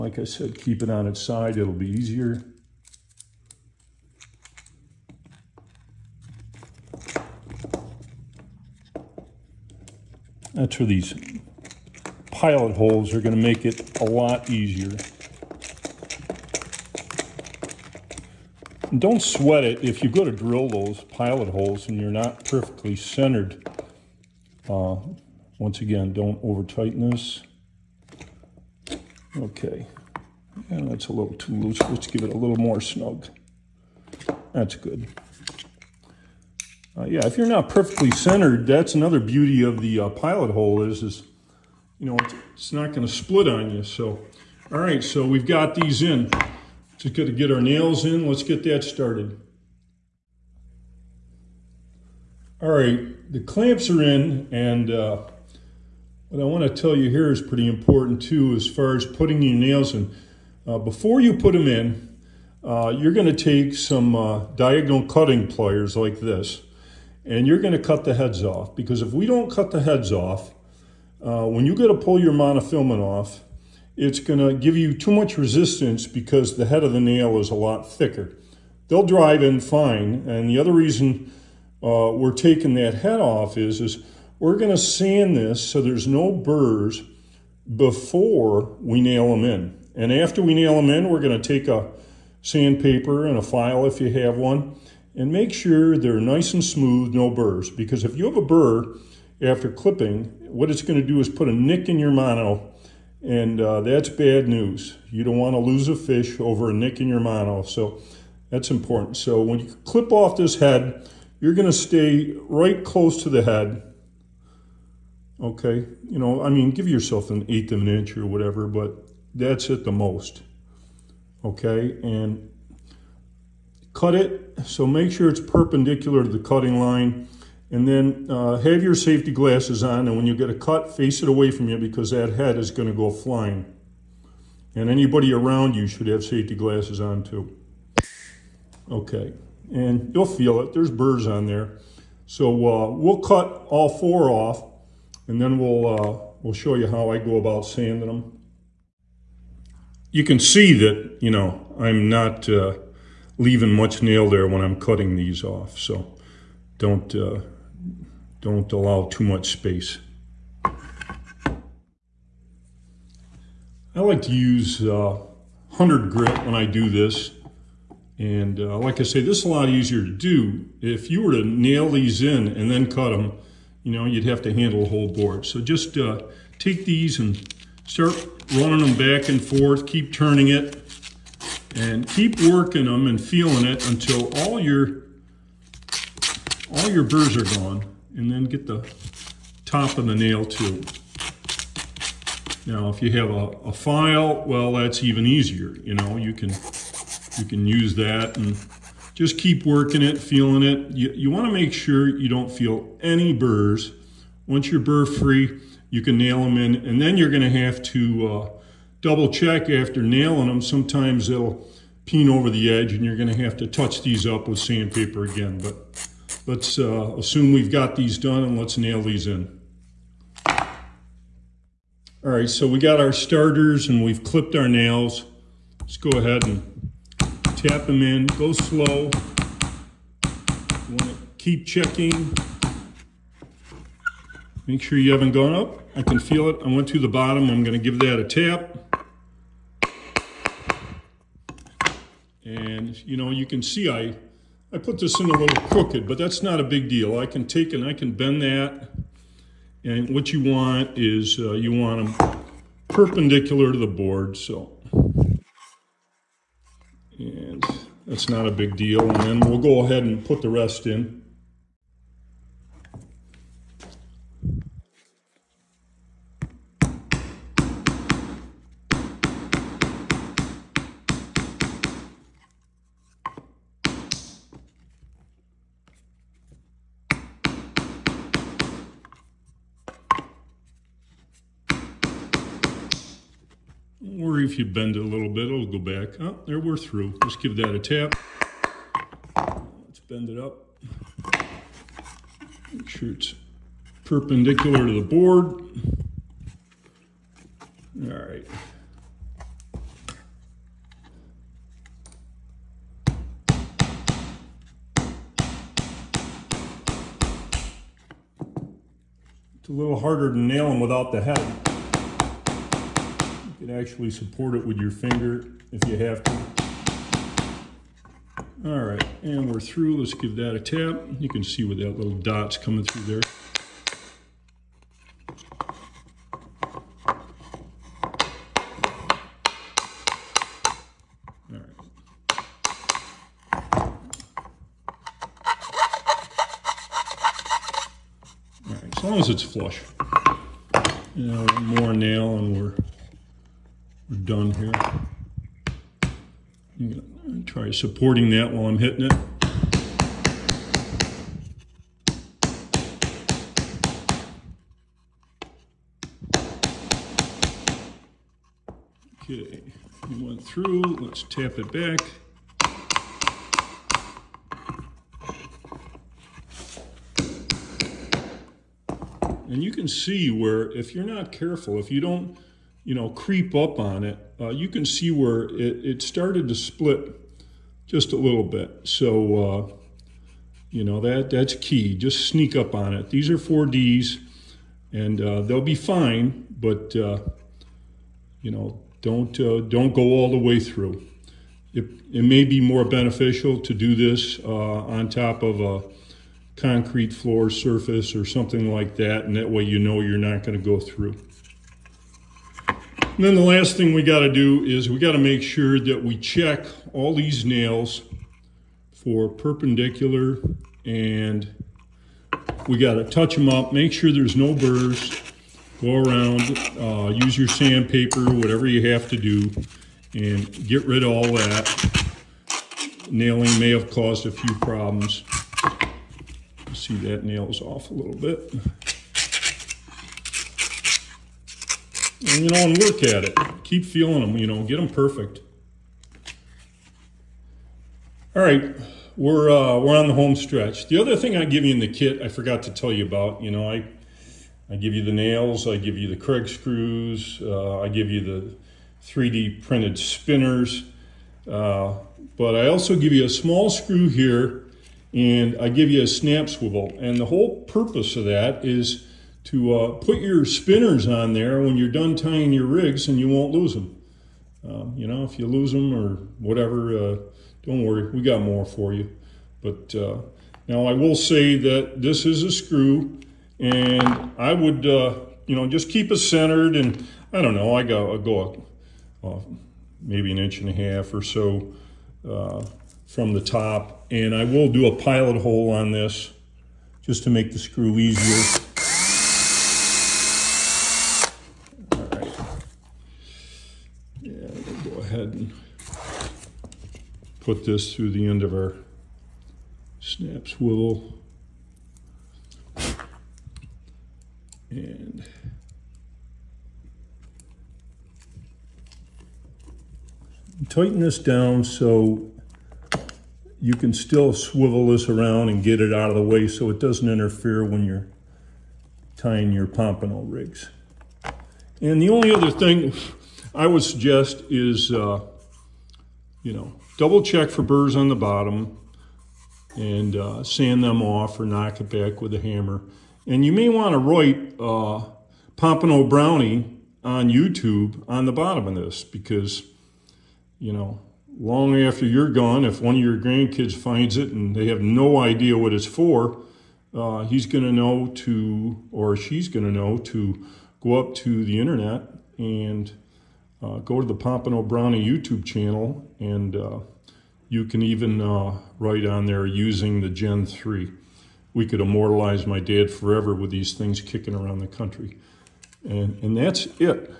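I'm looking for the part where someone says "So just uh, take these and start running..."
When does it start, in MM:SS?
02:55.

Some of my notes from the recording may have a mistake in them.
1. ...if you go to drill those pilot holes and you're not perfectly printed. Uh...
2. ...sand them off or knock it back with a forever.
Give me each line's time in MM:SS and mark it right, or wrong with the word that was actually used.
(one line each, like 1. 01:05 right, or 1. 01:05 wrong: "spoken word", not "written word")
1. 00:19 wrong: "centered", not "printed"
2. 08:50 wrong: "hammer", not "forever".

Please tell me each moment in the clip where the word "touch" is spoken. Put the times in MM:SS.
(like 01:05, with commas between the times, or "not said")
03:33, 06:53.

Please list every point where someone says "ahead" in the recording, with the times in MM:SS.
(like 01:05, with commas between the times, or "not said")
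03:46, 04:19, 08:15.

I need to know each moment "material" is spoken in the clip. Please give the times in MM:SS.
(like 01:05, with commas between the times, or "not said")
not said.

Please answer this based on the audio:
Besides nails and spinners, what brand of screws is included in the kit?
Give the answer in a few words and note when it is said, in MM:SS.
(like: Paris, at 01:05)
Kreg, at 07:26.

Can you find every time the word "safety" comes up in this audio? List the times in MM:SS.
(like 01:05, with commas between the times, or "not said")
02:08, 02:16.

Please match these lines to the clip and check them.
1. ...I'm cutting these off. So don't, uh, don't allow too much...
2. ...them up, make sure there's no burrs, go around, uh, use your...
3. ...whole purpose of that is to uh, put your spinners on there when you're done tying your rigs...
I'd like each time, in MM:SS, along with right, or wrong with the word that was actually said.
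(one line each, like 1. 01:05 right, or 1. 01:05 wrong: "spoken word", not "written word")
1. 02:34 right
2. 06:53 right
3. 07:37 right.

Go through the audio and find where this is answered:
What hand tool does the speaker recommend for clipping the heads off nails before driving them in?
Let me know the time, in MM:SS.
01:04.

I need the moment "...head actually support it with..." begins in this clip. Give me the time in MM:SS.
05:11.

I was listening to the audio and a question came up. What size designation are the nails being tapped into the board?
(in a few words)
4D.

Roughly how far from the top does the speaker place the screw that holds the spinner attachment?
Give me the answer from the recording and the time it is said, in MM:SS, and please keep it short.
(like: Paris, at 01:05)
an inch and a half, at 08:00.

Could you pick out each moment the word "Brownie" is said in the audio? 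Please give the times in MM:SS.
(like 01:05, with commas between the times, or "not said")
08:56, 09:14.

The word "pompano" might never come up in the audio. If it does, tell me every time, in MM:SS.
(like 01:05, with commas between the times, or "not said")
08:39, 08:55, 09:14.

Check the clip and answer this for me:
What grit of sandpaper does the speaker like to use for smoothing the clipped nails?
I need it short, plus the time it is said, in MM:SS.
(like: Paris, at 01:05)
100 grit, at 02:45.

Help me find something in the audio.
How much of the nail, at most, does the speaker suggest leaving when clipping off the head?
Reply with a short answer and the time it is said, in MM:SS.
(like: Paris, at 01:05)
an eighth of an inch, at 01:57.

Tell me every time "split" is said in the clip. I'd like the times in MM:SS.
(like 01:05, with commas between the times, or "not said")
00:43, 06:16.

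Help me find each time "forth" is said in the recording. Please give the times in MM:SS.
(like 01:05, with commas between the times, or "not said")
02:59.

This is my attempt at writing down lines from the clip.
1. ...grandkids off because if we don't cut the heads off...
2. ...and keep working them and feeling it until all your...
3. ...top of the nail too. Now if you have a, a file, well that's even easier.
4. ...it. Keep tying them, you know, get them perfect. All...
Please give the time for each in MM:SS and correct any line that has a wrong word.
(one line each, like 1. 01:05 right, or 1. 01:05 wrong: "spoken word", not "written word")
1. 01:08 wrong: "heads", not "grandkids"
2. 03:01 right
3. 03:09 right
4. 07:13 wrong: "feeling", not "tying".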